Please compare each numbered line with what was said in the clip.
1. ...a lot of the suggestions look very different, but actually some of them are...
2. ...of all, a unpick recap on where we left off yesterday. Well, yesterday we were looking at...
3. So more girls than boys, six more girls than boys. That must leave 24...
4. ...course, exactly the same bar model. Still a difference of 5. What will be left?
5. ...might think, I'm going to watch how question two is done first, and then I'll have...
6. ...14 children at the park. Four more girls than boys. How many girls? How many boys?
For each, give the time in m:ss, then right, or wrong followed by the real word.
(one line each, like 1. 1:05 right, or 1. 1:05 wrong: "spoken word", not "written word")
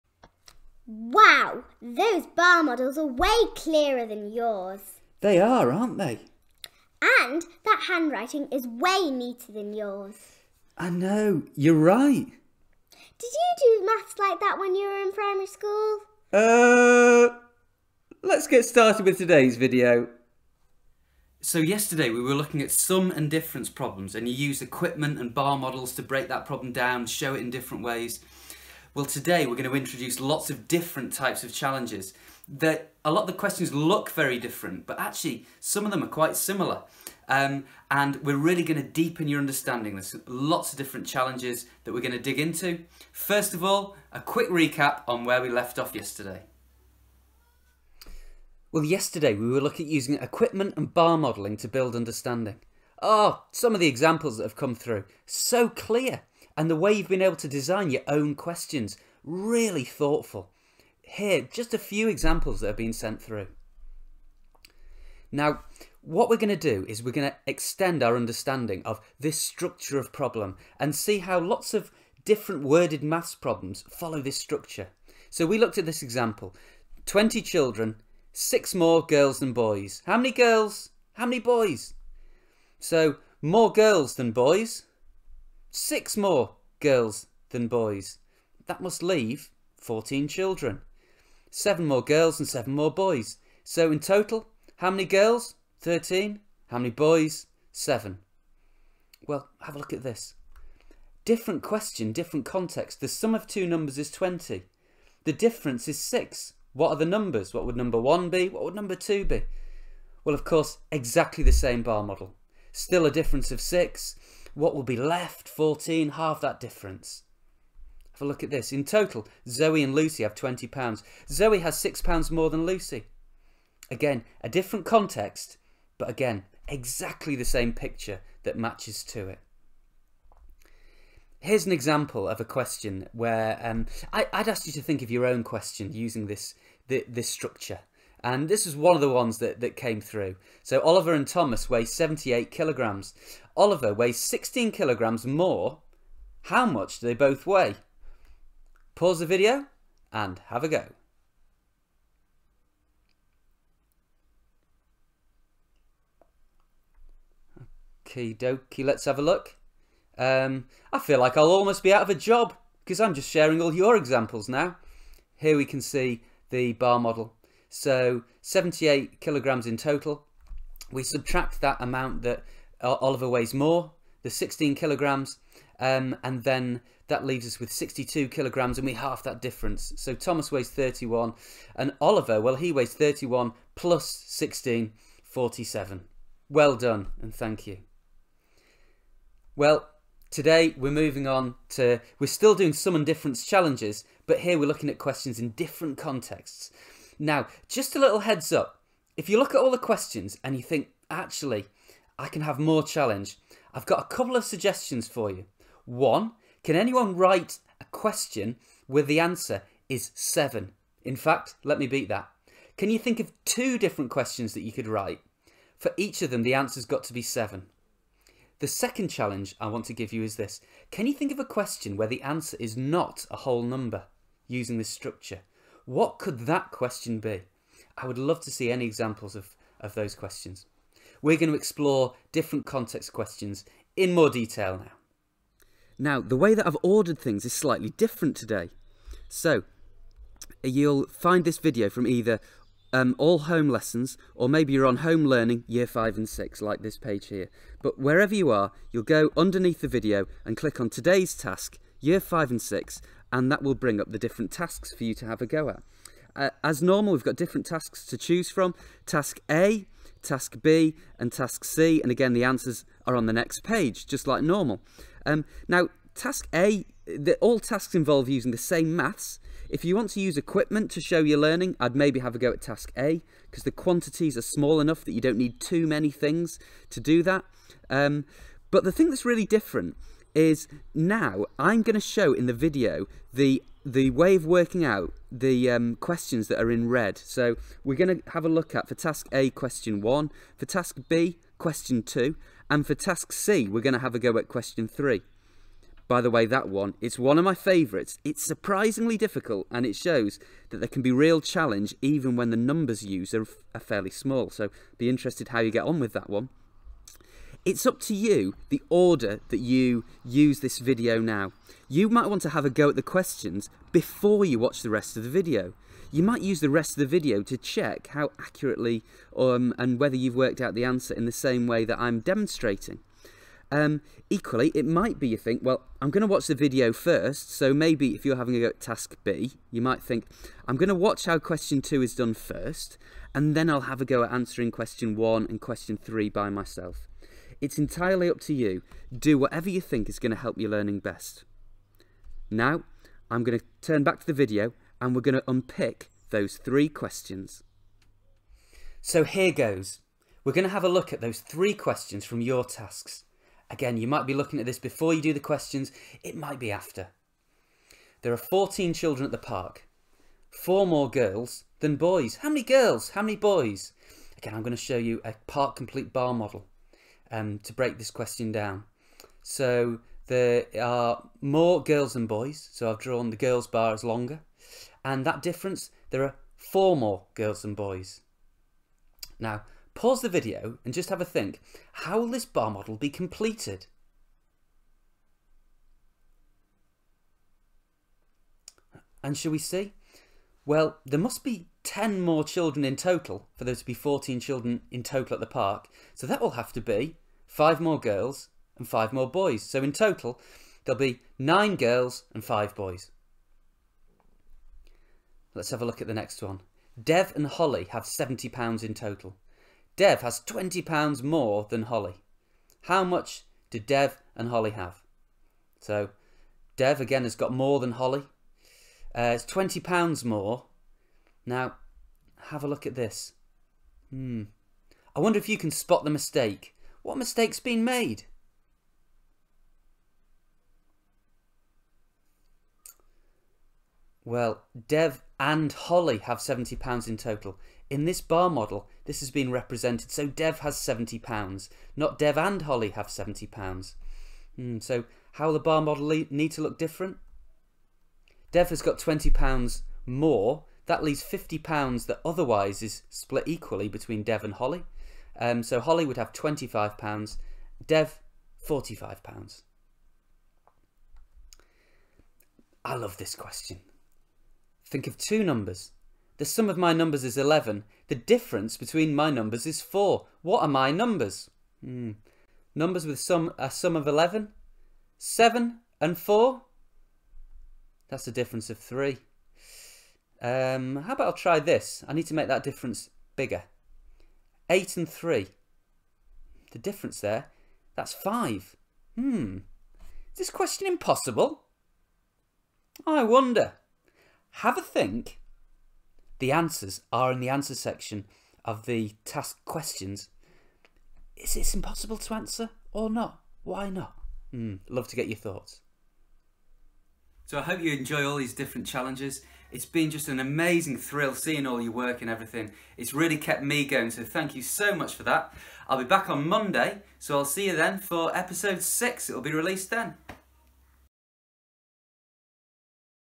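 1. 0:33 wrong: "questions", not "suggestions"
2. 0:43 wrong: "quick", not "unpick"
3. 1:22 wrong: "14", not "24"
4. 1:50 wrong: "6", not "5"
5. 5:29 right
6. 5:58 right.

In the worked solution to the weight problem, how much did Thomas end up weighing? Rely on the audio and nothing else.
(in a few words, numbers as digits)
31.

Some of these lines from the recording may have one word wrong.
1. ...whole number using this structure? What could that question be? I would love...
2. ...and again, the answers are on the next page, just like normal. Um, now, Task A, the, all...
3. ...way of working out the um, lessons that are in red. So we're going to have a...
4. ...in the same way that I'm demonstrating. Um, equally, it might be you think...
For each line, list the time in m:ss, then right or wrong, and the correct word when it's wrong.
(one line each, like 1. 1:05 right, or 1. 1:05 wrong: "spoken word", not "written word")
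1. 3:43 right
2. 4:22 right
3. 4:44 wrong: "questions", not "lessons"
4. 5:21 right.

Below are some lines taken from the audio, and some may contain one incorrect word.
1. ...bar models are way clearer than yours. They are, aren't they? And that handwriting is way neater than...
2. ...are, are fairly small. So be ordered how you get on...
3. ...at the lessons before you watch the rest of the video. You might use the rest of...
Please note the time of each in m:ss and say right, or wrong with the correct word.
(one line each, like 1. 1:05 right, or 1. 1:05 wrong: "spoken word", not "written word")
1. 0:02 right
2. 5:03 wrong: "interested", not "ordered"
3. 5:12 wrong: "questions", not "lessons".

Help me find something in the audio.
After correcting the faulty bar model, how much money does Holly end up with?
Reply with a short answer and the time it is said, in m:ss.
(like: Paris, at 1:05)
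£25, at 7:35.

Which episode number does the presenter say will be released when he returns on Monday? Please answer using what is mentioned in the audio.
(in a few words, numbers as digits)
6.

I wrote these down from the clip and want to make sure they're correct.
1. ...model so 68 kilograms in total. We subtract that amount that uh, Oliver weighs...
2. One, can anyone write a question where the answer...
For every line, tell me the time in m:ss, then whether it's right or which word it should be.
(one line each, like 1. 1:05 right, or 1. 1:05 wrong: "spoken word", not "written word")
1. 2:46 wrong: "78", not "68"
2. 3:25 right.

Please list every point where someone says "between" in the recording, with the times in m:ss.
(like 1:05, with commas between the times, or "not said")
7:33, 7:48.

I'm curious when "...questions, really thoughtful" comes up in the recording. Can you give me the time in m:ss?
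0:58.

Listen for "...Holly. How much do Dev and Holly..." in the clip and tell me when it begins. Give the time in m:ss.
6:51.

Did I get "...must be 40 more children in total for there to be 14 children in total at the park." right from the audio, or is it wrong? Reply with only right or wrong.
wrong.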